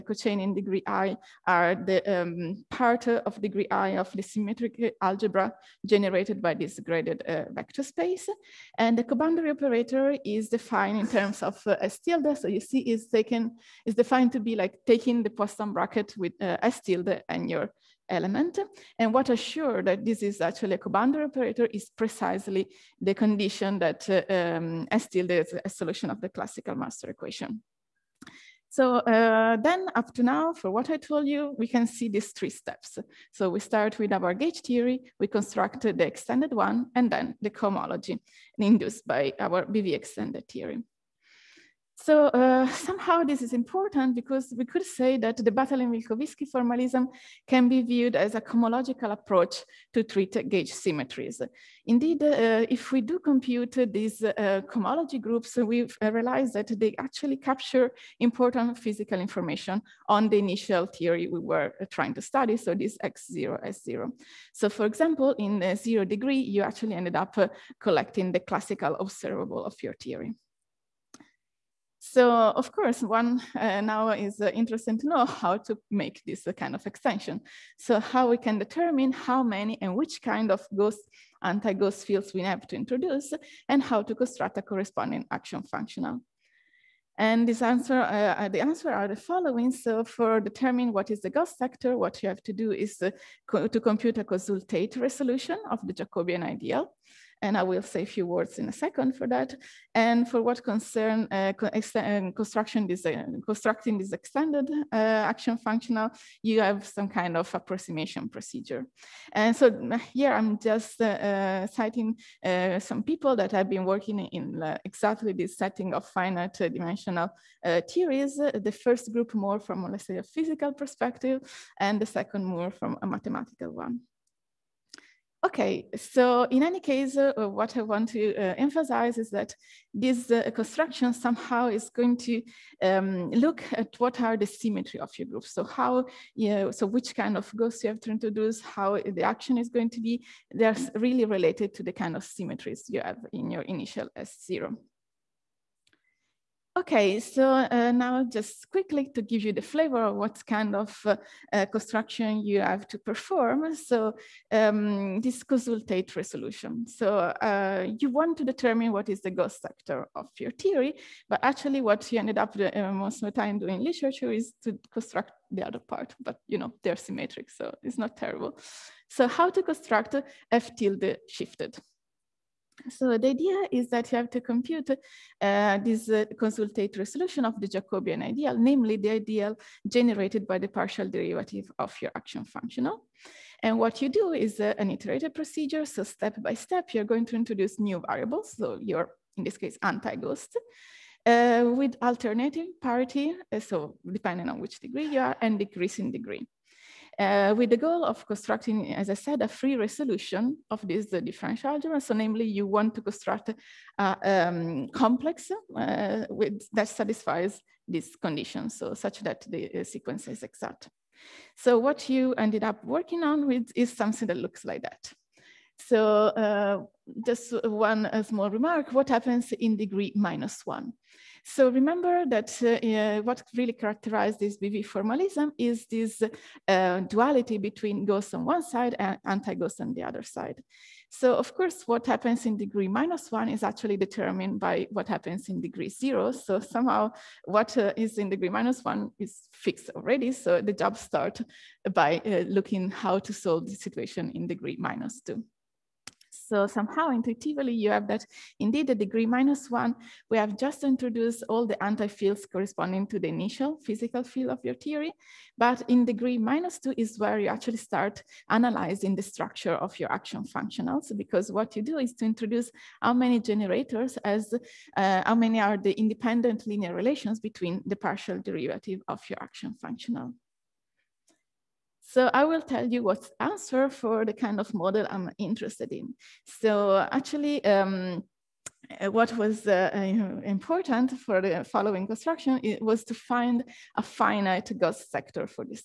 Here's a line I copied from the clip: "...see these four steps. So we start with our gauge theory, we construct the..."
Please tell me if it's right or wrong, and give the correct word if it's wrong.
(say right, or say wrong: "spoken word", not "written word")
wrong: "three", not "four".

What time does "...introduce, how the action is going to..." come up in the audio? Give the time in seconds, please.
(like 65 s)
138 s.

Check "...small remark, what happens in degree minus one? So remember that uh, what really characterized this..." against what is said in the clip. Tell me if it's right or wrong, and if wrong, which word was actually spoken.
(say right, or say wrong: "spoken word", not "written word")
right.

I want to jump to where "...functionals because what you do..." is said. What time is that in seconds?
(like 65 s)
260 s.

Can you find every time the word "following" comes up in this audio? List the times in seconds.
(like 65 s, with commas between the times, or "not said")
89 s, 281 s.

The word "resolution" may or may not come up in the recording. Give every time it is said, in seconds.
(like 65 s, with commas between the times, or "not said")
94 s, 156 s, 176 s, 199 s.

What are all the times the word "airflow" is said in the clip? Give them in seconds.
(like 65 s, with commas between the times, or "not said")
not said.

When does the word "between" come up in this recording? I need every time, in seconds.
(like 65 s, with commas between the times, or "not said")
227 s, 267 s.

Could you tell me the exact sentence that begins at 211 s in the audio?
So what you ended up working on with is something that looks like that.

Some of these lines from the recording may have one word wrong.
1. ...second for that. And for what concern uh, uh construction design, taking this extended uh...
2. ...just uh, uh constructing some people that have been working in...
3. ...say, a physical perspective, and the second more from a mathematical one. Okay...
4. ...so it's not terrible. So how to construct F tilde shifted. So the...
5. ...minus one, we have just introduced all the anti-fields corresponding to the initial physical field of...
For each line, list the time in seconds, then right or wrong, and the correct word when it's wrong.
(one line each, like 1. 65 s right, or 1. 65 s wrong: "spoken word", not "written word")
1. 98 s wrong: "constructing", not "taking"
2. 110 s wrong: "citing", not "constructing"
3. 120 s right
4. 167 s right
5. 249 s right.